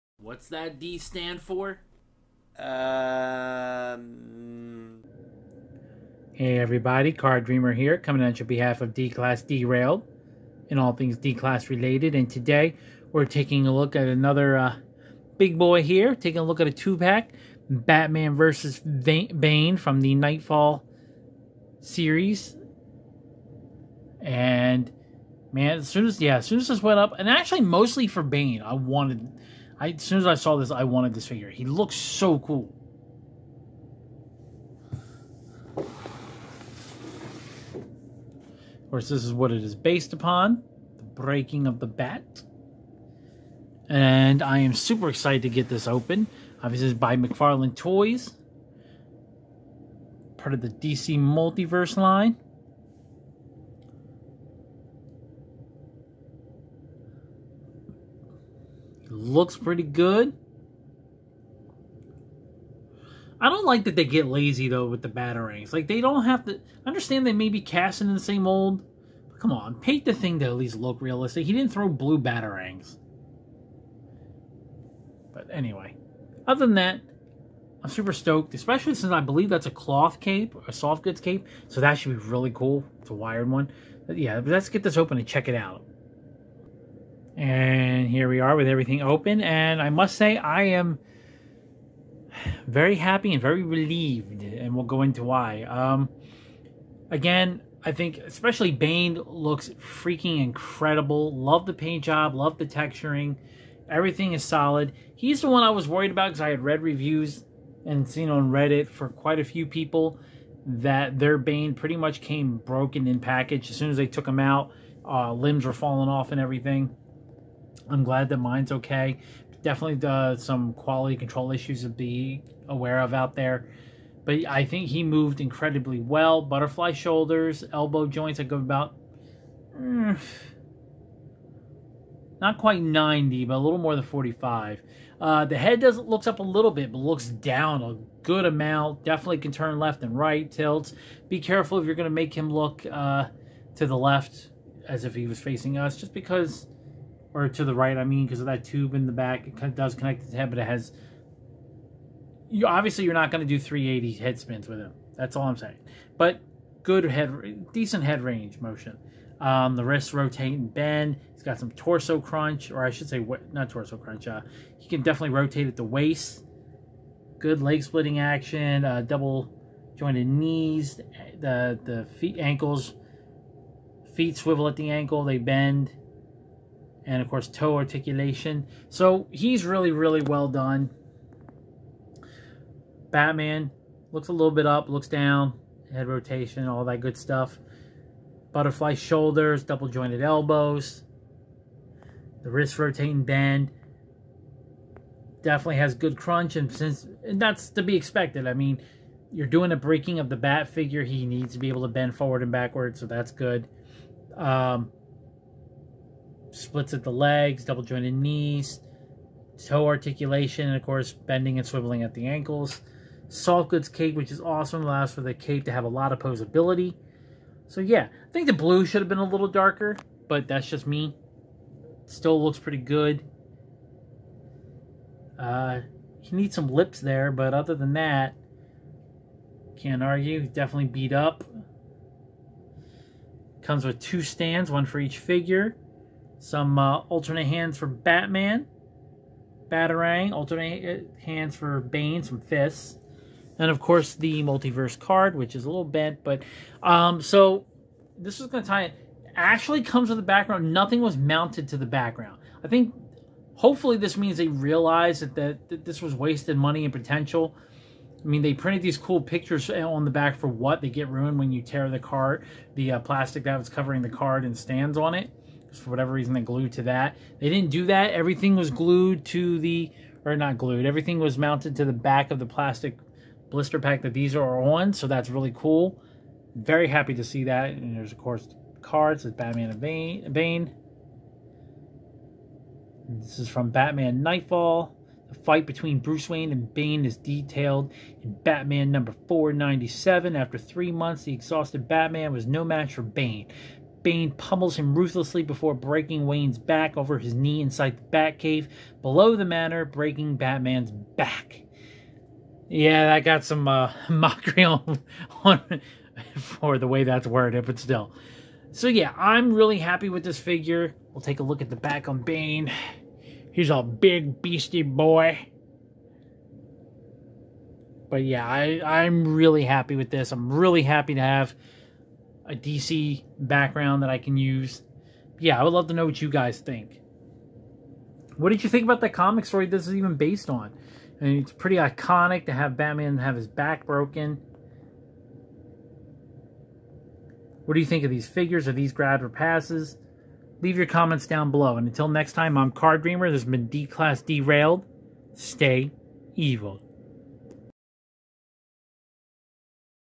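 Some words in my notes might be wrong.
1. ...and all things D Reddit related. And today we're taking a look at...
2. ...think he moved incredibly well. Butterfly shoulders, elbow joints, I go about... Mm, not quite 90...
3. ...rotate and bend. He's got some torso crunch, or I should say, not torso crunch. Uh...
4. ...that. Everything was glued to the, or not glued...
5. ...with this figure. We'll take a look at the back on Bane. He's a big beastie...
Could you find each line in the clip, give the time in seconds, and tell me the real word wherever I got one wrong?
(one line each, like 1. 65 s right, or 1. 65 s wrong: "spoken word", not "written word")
1. 10 s wrong: "Class", not "Reddit"
2. 124 s right
3. 160 s right
4. 267 s right
5. 310 s right.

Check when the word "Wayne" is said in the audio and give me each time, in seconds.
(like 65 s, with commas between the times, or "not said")
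286 s, 296 s.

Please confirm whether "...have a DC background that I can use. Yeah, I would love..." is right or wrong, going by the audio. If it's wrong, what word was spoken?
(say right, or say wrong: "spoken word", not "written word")
right.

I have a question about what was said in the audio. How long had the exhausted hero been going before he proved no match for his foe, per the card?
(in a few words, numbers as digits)
3 months.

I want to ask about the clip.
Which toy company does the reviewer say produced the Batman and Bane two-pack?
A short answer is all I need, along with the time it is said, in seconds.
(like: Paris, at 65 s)
McFarlane Toys, at 47 s.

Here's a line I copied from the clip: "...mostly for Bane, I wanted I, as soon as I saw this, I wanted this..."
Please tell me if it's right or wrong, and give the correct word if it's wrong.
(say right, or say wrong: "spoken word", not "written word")
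right.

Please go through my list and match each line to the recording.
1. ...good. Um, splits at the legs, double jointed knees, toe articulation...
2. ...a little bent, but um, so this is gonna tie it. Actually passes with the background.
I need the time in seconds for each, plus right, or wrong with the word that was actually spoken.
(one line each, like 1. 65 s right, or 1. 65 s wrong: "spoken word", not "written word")
1. 203 s right
2. 245 s wrong: "comes", not "passes".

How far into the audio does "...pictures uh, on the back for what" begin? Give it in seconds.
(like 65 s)
259 s.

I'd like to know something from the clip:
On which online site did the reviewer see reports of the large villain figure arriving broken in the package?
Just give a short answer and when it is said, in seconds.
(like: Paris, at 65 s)
Reddit, at 108 s.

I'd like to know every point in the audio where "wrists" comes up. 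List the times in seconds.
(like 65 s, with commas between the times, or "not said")
159 s, 192 s.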